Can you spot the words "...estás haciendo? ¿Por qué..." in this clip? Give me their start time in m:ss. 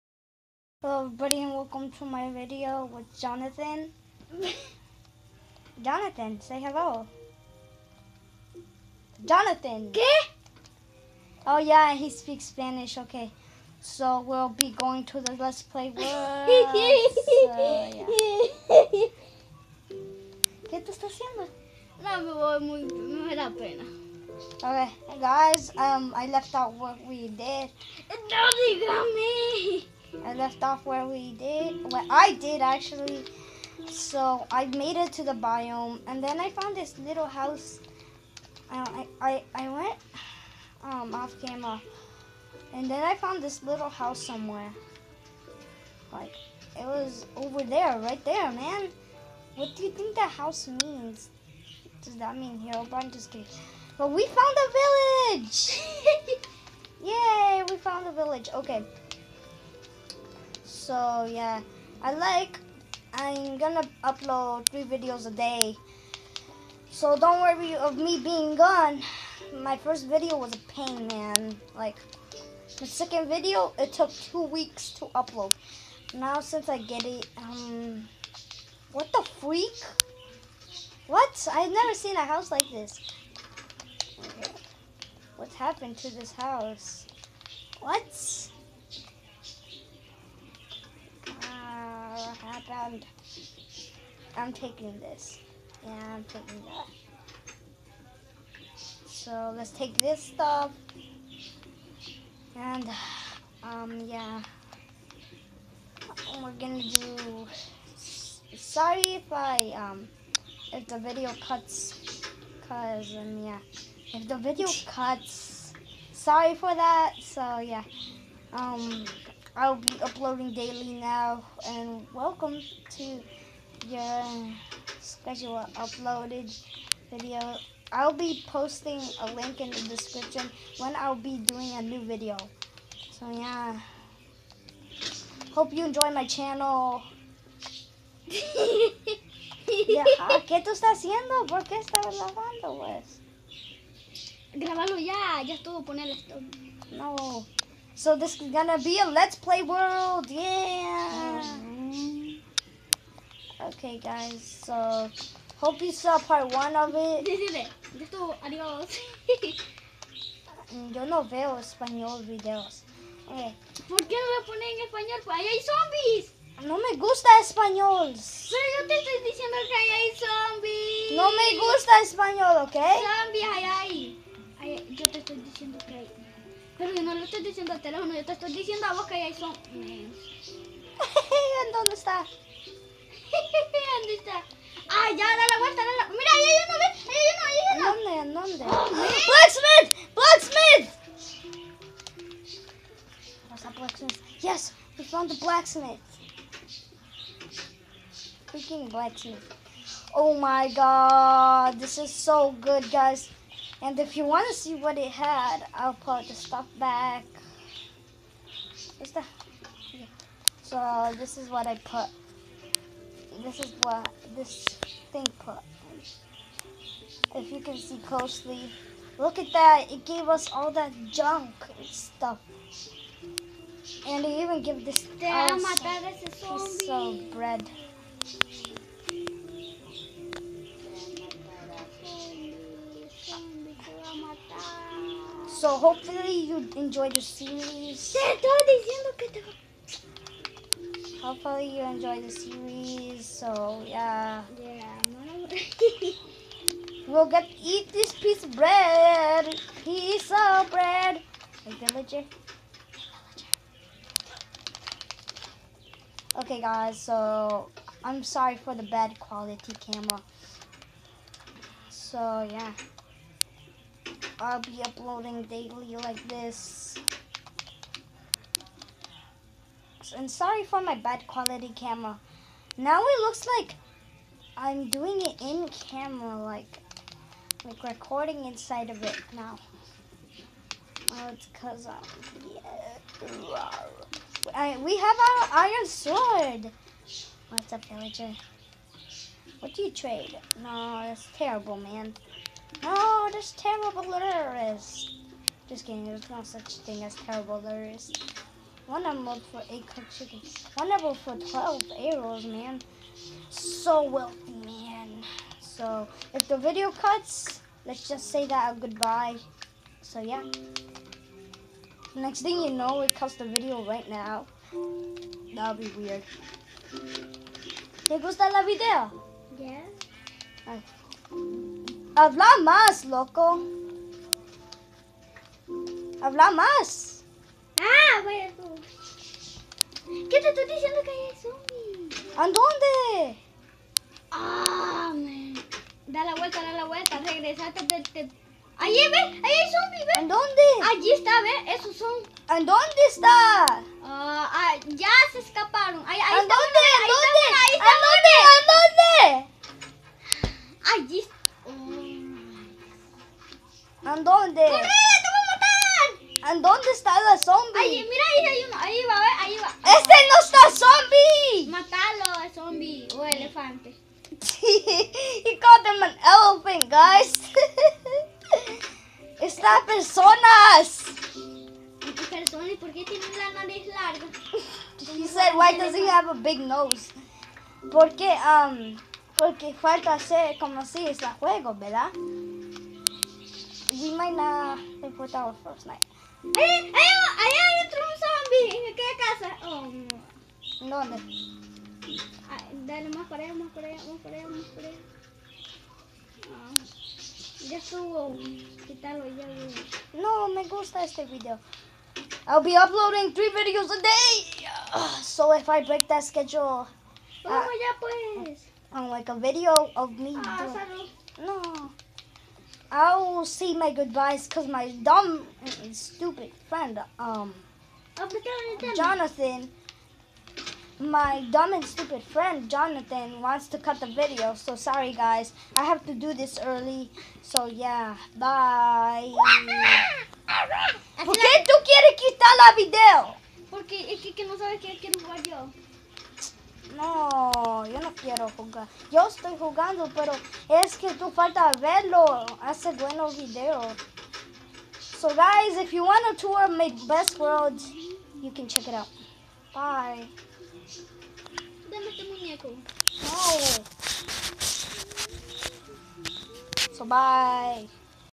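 2:20.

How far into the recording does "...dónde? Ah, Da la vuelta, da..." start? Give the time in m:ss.
5:32.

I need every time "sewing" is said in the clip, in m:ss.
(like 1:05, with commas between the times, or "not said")
not said.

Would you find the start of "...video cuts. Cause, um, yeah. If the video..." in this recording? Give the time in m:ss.
1:50.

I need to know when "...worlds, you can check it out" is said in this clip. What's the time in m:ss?
7:27.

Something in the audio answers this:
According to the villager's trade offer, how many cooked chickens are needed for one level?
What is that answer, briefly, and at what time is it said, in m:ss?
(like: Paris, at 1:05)
8, at 4:59.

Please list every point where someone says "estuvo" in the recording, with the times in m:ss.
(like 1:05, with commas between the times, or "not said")
2:25, 2:38.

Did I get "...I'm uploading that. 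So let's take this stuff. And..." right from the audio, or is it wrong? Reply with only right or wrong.
wrong.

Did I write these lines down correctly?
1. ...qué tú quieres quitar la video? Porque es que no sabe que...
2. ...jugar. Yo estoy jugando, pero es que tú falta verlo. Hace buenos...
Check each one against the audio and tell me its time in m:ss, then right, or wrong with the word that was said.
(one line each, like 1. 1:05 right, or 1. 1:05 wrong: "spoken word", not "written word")
1. 7:11 right
2. 7:18 right.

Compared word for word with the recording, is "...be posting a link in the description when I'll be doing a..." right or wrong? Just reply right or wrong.
right.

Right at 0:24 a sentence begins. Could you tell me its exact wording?
Okay, guys, um, I left out what we did.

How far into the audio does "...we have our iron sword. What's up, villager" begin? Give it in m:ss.
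4:44.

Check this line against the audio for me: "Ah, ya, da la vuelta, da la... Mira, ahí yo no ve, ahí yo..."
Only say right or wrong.
right.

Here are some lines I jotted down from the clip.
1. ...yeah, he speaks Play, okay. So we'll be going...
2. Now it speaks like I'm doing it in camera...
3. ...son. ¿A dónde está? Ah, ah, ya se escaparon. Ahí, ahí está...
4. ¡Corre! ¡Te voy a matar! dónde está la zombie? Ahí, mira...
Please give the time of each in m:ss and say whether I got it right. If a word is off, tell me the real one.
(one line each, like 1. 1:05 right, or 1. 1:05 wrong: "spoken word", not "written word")
1. 0:11 wrong: "Spanish", not "Play"
2. 4:32 wrong: "looks", not "speaks"
3. 5:41 right
4. 5:54 right.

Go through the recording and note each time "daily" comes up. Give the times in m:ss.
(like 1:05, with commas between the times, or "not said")
2:00, 4:25.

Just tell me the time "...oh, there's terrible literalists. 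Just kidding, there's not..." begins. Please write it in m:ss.
4:52.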